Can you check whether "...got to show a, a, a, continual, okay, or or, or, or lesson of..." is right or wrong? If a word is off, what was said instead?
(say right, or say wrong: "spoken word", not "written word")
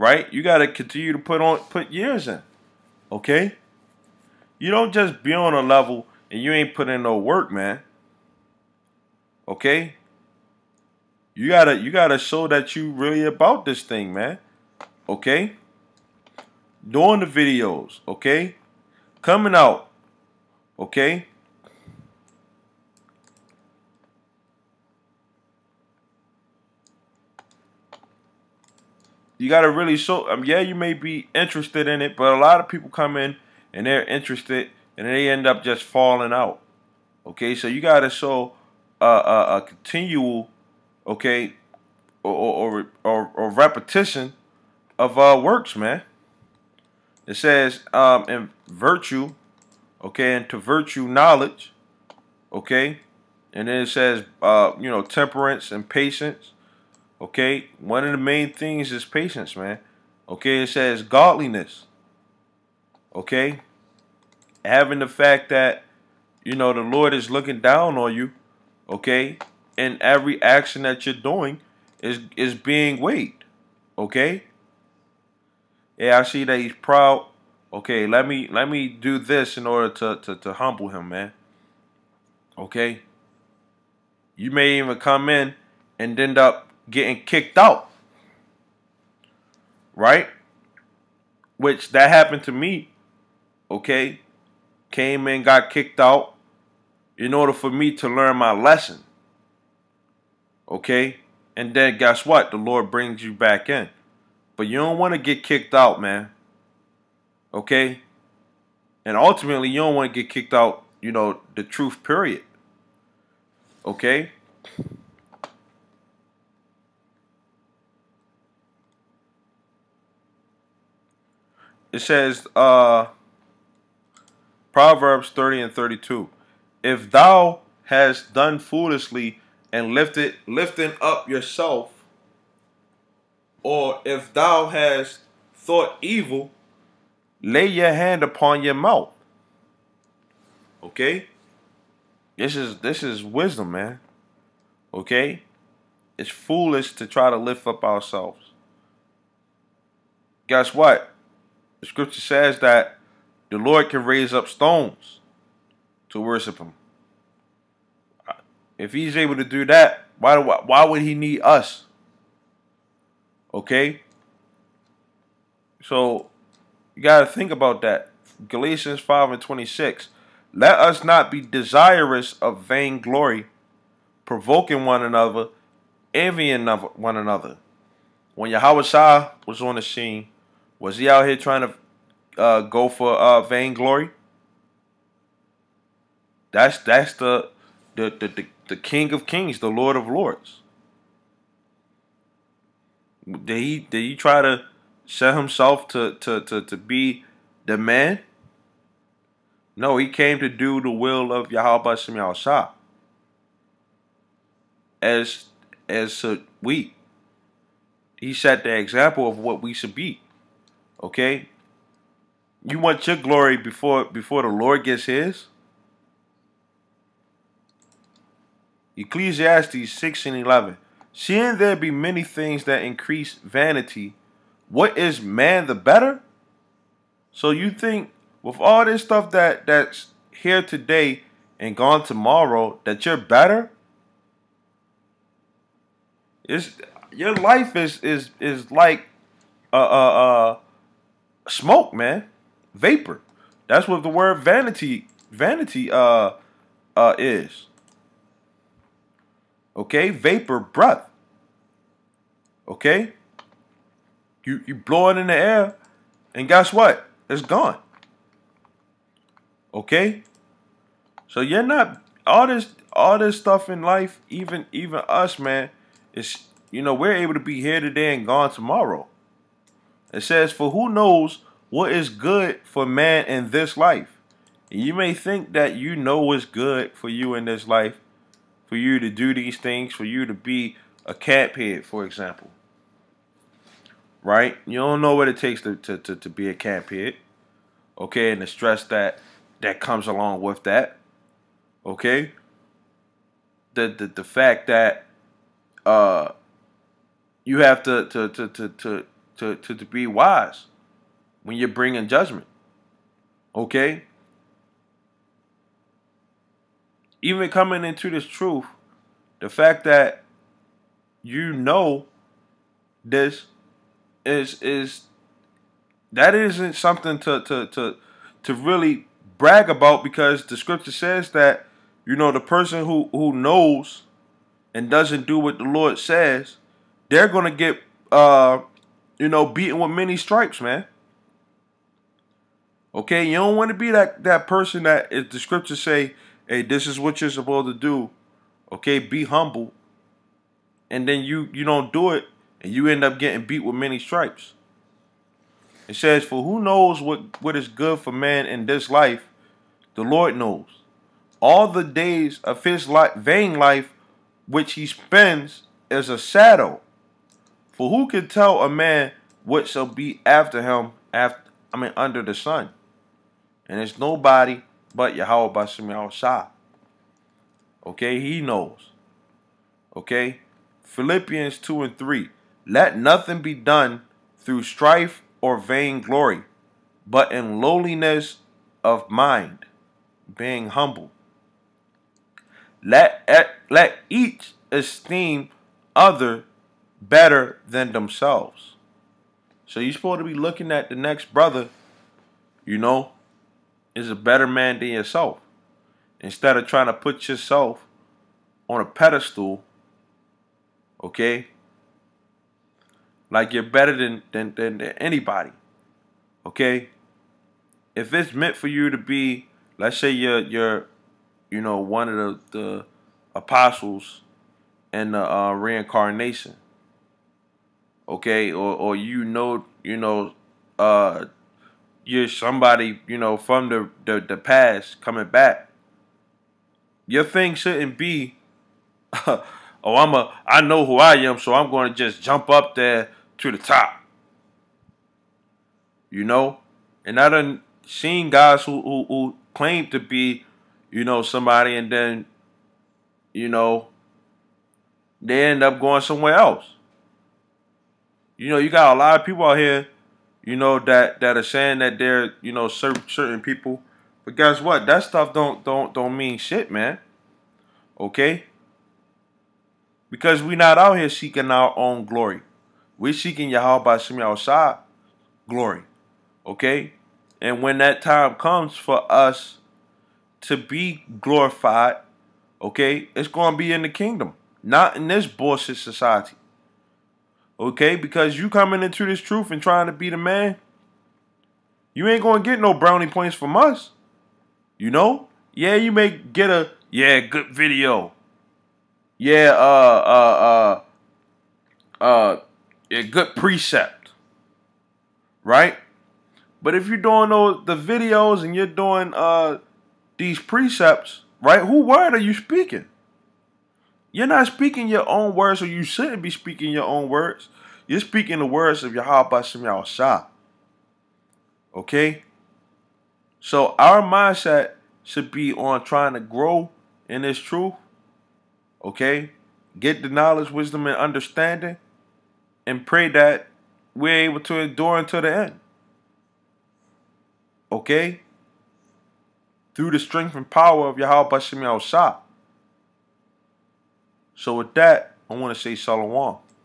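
wrong: "repetition", not "lesson".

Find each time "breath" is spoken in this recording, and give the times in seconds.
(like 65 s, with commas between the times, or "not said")
250 s.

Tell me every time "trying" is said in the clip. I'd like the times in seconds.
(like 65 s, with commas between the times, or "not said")
181 s, 396 s, 479 s, 515 s.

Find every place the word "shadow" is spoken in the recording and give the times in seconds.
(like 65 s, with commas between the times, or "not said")
356 s.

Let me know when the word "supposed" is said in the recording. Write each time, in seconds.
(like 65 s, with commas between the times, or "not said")
337 s, 389 s.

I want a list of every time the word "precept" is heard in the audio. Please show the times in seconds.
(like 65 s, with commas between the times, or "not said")
493 s, 500 s.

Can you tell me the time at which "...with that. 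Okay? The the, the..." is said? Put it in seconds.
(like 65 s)
290 s.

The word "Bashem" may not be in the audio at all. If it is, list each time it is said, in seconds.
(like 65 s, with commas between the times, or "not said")
365 s, 509 s, 531 s.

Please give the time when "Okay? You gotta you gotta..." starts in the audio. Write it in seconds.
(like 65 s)
9 s.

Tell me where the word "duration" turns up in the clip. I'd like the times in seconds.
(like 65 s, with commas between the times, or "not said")
not said.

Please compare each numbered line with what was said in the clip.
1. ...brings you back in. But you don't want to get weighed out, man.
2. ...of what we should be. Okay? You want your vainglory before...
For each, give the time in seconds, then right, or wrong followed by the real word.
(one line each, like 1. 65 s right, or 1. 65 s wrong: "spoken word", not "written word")
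1. 102 s wrong: "kicked", not "weighed"
2. 209 s wrong: "glory", not "vainglory".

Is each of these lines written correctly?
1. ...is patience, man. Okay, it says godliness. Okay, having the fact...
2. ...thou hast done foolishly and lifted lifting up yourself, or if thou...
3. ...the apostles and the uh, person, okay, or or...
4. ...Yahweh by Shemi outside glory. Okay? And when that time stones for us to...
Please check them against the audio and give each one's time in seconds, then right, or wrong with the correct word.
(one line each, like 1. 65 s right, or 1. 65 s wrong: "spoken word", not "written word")
1. 58 s right
2. 127 s right
3. 412 s wrong: "reincarnation", not "person"
4. 463 s wrong: "comes", not "stones".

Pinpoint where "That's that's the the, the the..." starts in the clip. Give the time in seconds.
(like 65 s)
186 s.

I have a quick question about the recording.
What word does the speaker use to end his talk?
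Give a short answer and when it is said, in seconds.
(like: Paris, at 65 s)
shalom, at 535 s.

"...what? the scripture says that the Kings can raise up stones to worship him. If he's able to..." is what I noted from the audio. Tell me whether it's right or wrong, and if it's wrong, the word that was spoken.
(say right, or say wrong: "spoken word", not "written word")
wrong: "Lord", not "Kings".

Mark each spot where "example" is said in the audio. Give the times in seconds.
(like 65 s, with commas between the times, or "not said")
208 s, 282 s.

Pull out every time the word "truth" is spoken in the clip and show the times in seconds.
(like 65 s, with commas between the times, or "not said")
111 s, 308 s, 479 s, 517 s.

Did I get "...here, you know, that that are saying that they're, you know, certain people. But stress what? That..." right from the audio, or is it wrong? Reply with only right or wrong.
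wrong.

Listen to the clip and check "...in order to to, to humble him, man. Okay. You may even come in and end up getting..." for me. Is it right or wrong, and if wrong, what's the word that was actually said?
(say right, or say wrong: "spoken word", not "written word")
right.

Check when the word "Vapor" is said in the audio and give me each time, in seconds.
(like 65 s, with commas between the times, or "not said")
242 s, 250 s.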